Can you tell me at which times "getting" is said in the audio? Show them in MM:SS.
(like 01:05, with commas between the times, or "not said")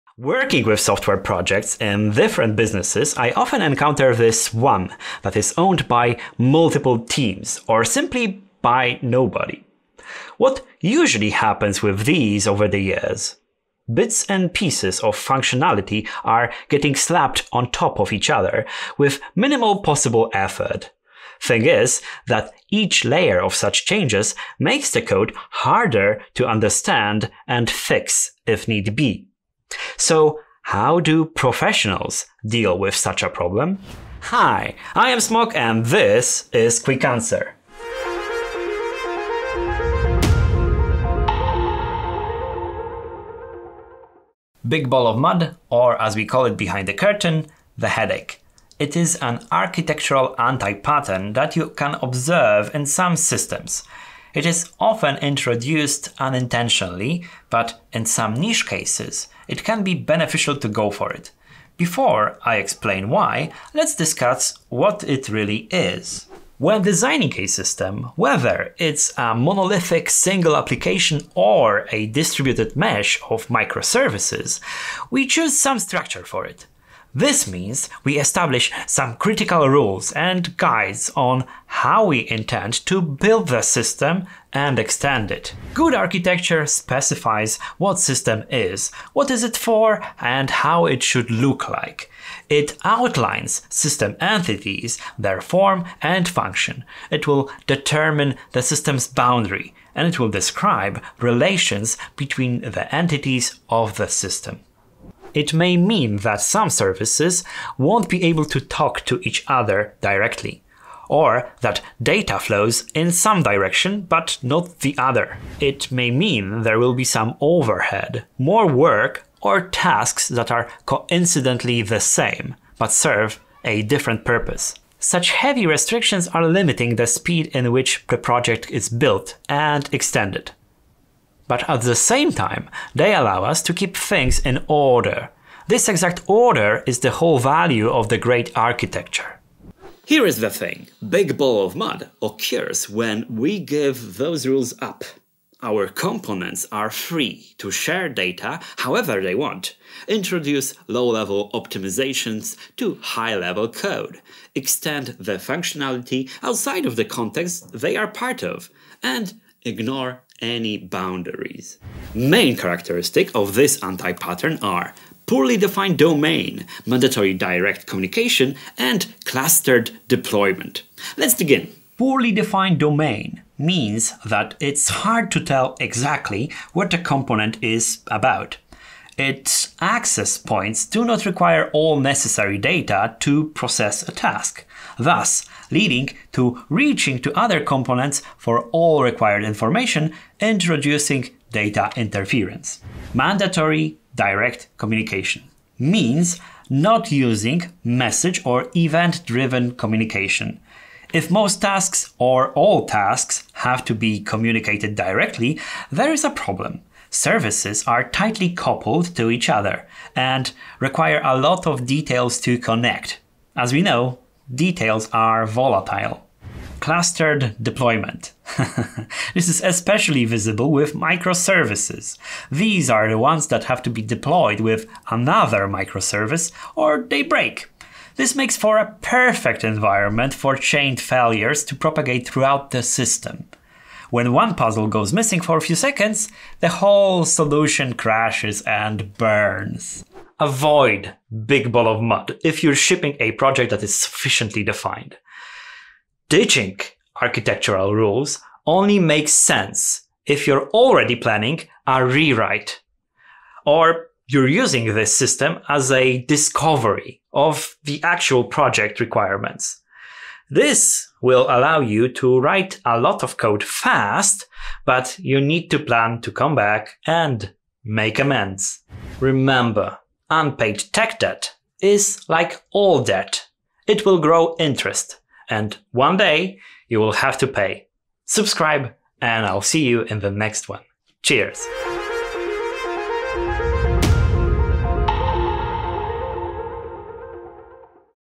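00:16.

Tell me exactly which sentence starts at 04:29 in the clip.
Remember, unpaid tech debt is like all debt.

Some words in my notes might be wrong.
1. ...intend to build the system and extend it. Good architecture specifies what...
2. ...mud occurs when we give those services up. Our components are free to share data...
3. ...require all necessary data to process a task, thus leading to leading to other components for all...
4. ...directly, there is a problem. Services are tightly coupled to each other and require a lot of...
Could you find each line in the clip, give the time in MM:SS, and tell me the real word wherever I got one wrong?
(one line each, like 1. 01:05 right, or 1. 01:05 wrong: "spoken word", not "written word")
1. 01:22 right
2. 02:21 wrong: "rules", not "services"
3. 03:01 wrong: "reaching", not "leading"
4. 03:24 right.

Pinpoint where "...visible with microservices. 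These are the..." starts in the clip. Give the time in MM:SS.
03:40.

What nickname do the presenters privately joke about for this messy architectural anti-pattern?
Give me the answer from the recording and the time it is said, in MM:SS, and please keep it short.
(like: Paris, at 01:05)
the headache, at 00:47.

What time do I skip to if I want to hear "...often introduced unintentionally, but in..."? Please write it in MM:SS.
00:54.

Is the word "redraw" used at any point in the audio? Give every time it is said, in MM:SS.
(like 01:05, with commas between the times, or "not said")
not said.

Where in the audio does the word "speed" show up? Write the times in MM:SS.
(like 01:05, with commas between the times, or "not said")
02:07.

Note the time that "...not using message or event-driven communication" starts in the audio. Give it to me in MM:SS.
03:16.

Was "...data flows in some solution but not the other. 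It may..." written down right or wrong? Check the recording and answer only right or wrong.
wrong.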